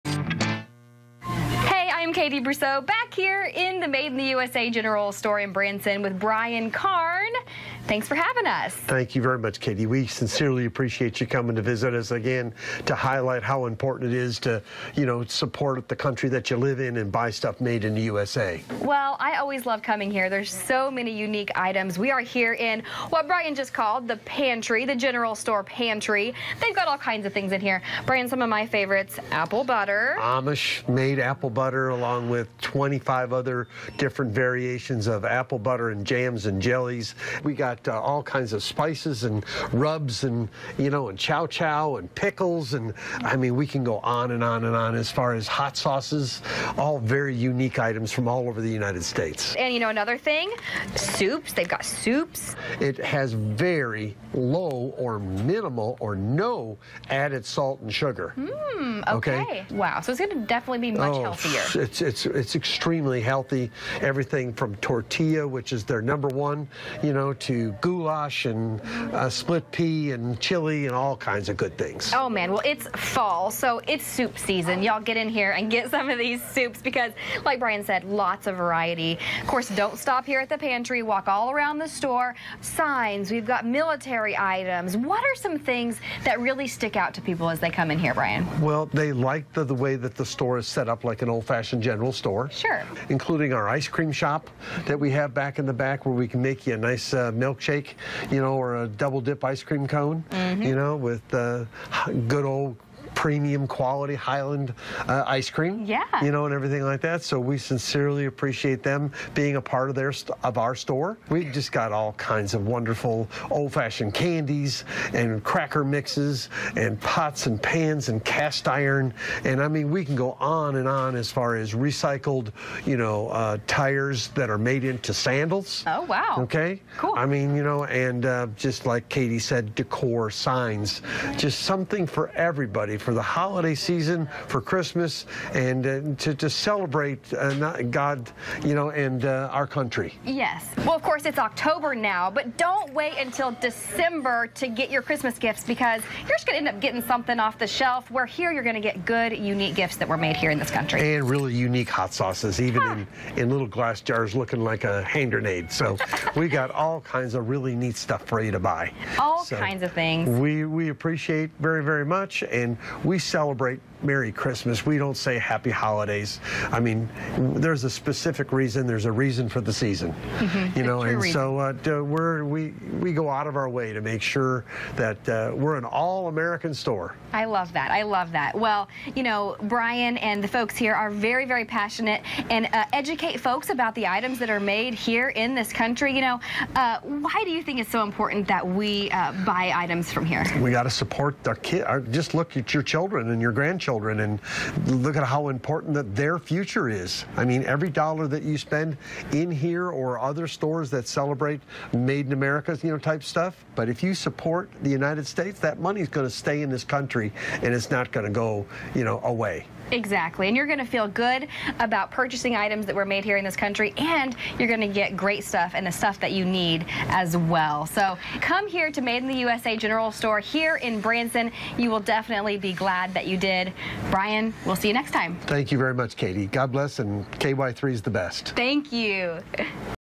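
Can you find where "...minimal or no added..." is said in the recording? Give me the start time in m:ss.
0:55.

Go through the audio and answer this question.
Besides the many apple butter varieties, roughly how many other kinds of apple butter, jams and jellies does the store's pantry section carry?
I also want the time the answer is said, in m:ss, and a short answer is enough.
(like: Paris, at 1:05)
25, at 0:32.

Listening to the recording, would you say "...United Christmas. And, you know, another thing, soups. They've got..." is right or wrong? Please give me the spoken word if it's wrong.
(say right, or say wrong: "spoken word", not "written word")
wrong: "States", not "Christmas".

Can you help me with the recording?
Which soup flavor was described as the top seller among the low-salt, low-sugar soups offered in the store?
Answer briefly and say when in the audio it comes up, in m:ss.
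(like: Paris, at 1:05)
Tortilla, at 1:04.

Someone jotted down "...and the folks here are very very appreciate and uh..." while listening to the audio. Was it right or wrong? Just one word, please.
wrong.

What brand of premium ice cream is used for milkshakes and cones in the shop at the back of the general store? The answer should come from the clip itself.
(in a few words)
Hiland.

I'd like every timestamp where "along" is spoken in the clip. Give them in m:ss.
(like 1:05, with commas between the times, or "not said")
0:31.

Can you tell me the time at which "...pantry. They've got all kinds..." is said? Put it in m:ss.
0:25.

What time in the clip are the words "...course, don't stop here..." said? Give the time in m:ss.
1:19.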